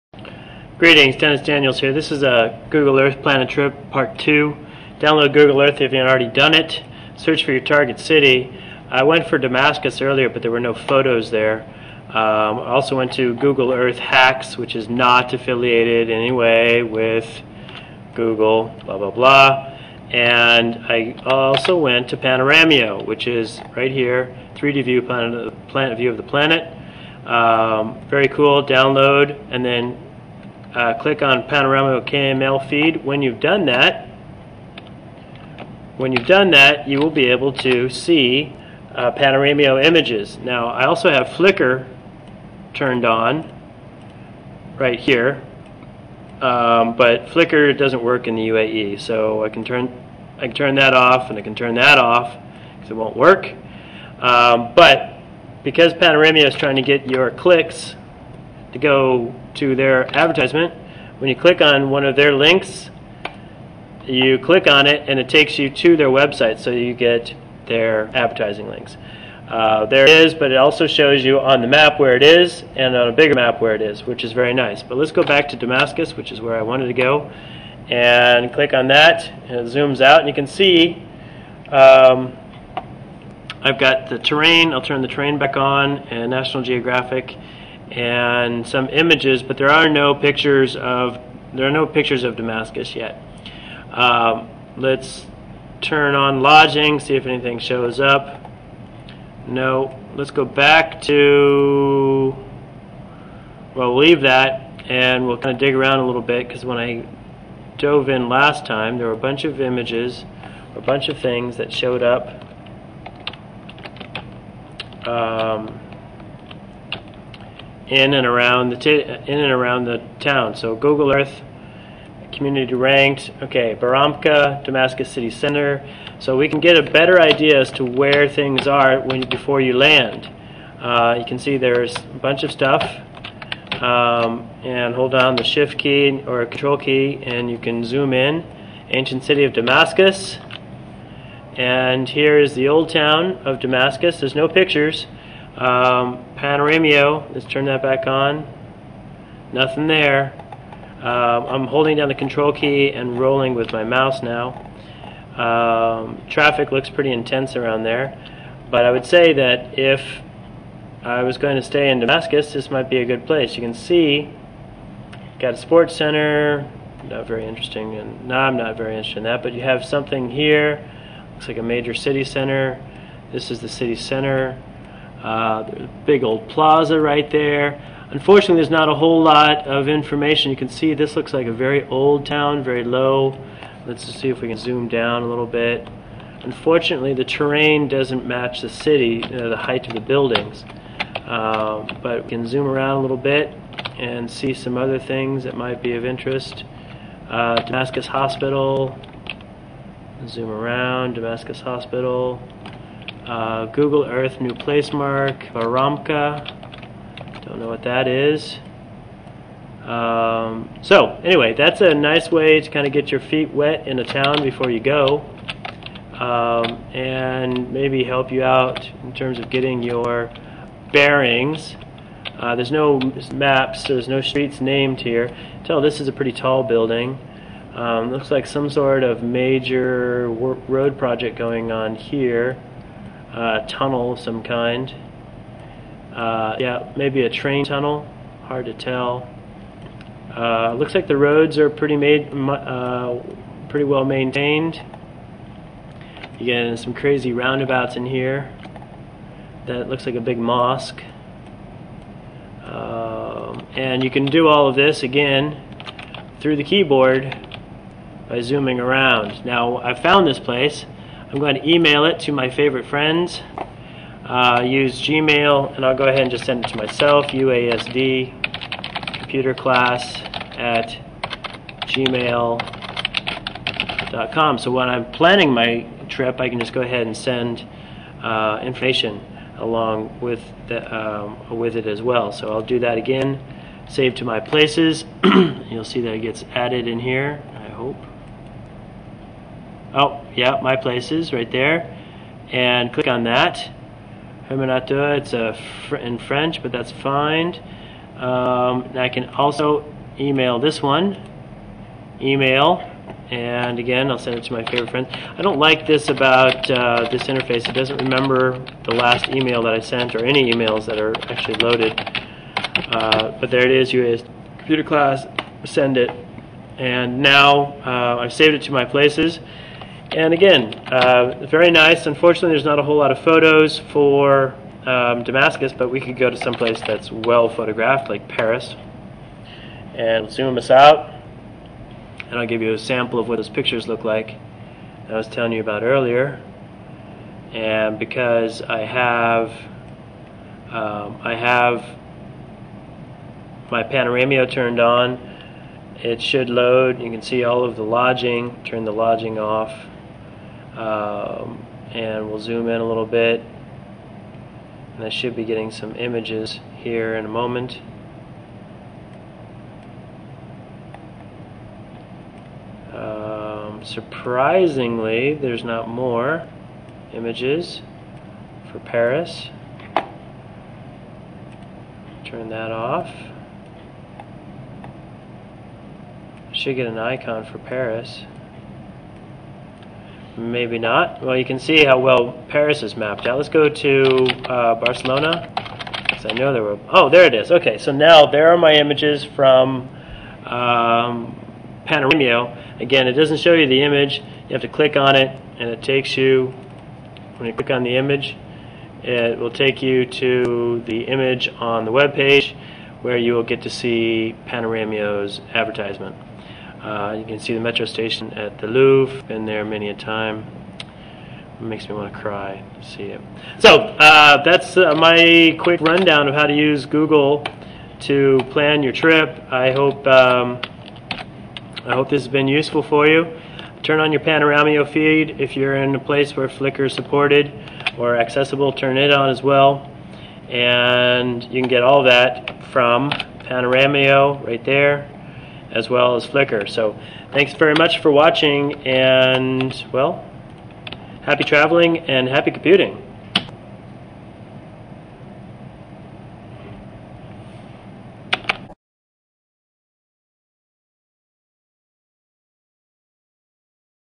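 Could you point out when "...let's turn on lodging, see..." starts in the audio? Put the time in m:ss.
1:34.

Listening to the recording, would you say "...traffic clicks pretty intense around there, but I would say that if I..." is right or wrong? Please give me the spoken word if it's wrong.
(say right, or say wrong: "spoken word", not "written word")
wrong: "looks", not "clicks".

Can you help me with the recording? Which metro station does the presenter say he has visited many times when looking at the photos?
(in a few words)
the Louvre.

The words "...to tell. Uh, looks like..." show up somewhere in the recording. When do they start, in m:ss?
3:58.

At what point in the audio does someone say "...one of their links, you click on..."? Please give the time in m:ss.
1:01.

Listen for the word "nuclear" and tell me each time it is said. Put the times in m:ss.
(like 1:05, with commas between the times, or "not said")
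not said.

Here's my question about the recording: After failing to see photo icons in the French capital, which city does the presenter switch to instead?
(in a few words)
Barcelona.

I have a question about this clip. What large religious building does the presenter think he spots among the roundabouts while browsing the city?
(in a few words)
a big mosque.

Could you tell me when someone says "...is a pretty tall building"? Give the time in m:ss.
3:45.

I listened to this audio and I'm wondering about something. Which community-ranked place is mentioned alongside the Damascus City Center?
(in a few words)
Baramka.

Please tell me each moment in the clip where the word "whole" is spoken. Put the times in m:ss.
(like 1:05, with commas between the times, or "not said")
2:58, 5:22.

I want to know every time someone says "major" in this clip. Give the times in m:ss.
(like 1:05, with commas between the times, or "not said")
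2:51, 3:49.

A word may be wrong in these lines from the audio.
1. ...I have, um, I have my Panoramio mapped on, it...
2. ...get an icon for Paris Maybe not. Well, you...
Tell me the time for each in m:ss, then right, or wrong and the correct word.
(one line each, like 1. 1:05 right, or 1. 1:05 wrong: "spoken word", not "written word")
1. 5:38 wrong: "turned", not "mapped"
2. 6:16 right.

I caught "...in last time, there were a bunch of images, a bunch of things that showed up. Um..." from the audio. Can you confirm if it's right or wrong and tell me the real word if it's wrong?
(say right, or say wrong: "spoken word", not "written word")
right.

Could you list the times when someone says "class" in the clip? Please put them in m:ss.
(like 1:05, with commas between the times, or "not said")
4:29, 5:14.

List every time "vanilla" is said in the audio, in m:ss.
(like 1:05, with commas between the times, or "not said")
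not said.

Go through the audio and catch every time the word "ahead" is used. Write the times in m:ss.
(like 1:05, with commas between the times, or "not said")
4:26, 4:36.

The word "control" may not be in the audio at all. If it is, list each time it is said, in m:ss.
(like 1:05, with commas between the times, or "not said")
2:16, 2:32.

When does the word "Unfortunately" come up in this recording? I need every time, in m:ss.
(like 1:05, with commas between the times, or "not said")
2:58, 3:06, 5:22.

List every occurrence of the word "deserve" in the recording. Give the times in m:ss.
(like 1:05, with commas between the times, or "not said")
not said.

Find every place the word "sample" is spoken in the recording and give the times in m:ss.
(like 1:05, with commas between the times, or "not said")
5:32.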